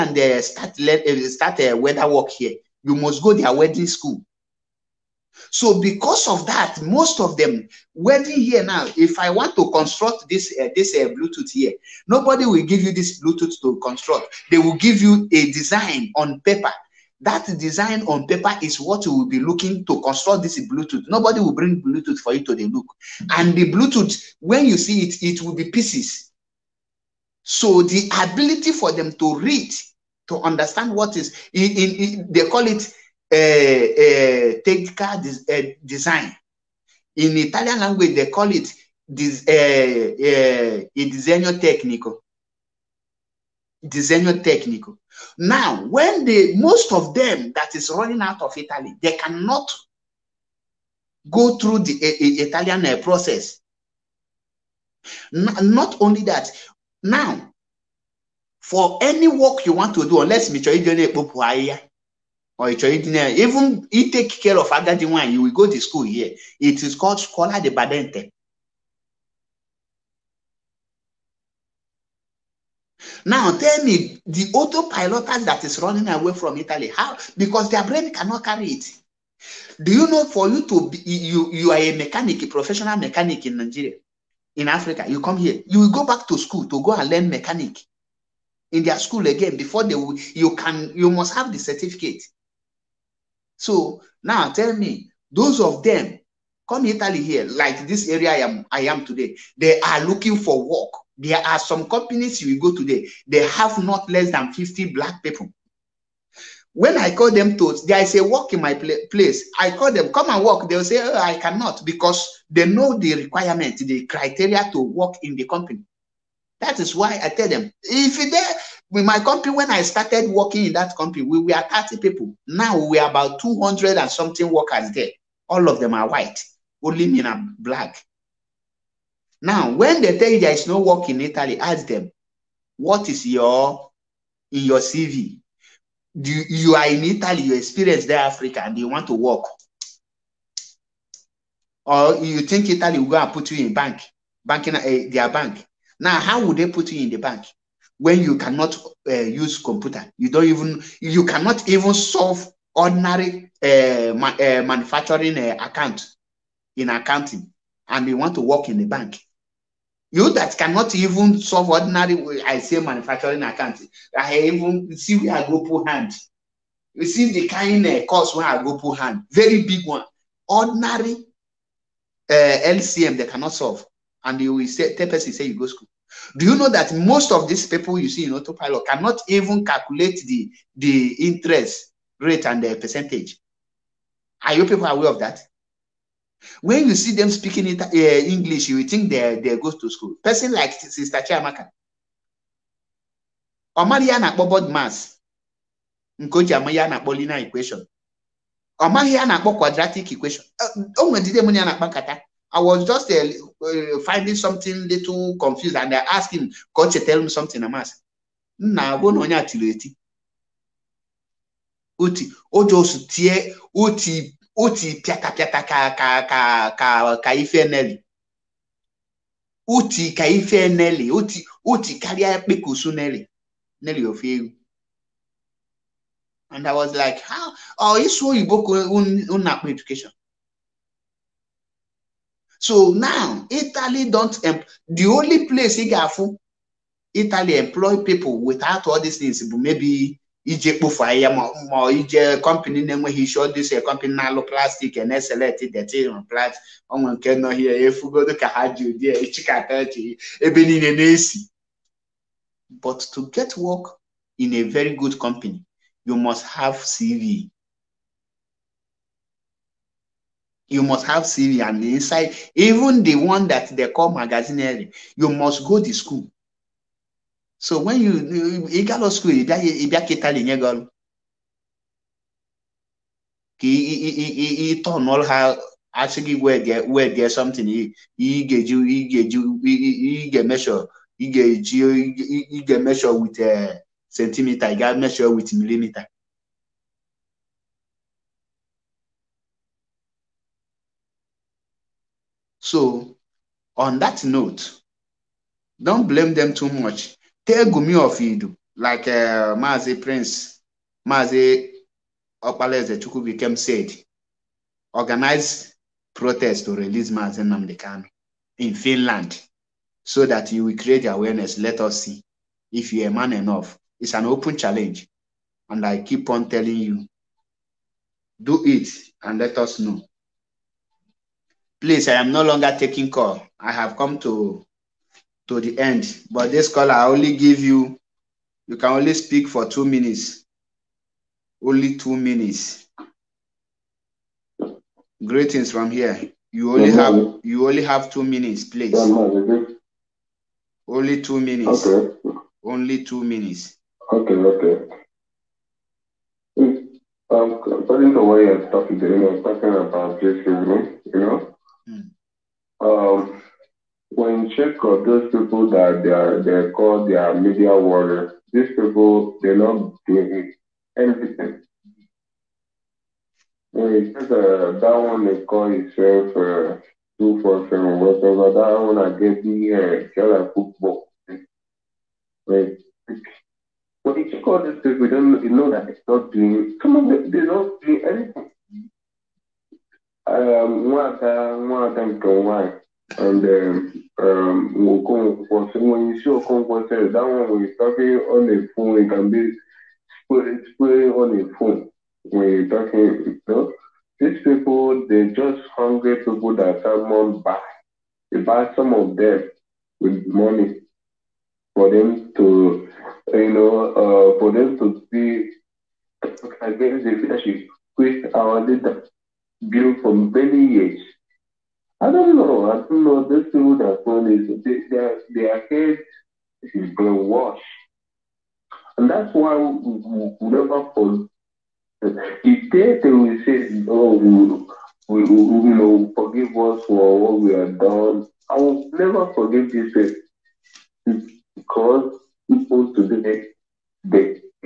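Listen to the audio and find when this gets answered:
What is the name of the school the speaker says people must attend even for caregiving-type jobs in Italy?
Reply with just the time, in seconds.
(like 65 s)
67 s.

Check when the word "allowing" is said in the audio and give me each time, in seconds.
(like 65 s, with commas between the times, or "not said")
not said.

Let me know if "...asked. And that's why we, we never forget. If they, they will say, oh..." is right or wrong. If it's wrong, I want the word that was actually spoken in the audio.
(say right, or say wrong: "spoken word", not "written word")
wrong: "brainwashed", not "asked".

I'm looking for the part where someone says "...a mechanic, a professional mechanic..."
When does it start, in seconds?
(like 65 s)
81 s.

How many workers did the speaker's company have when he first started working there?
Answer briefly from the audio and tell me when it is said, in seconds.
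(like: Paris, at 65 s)
30, at 121 s.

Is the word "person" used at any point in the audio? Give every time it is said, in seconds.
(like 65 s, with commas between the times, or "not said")
175 s, 190 s.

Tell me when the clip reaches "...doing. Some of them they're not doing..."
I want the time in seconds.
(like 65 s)
376 s.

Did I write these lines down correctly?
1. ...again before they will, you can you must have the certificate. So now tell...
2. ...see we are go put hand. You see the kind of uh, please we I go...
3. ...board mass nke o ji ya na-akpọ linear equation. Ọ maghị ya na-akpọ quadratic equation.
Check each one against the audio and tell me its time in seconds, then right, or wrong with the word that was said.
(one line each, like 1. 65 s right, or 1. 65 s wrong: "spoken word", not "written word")
1. 89 s right
2. 164 s wrong: "course", not "please"
3. 194 s right.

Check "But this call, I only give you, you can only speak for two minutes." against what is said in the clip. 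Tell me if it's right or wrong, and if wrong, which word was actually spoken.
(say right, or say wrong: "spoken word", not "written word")
right.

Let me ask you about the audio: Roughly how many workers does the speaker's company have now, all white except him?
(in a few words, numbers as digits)
About 200.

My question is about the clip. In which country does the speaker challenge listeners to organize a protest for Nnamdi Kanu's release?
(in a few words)
Finland.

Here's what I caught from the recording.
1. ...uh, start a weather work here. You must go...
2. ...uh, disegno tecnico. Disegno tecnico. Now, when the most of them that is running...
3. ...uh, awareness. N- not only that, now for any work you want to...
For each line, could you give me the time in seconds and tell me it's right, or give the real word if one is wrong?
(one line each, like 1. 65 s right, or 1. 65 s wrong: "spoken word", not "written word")
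1. 0 s right
2. 39 s right
3. 52 s wrong: "process", not "awareness".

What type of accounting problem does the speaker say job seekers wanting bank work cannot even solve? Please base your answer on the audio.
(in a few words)
Manufacturing account.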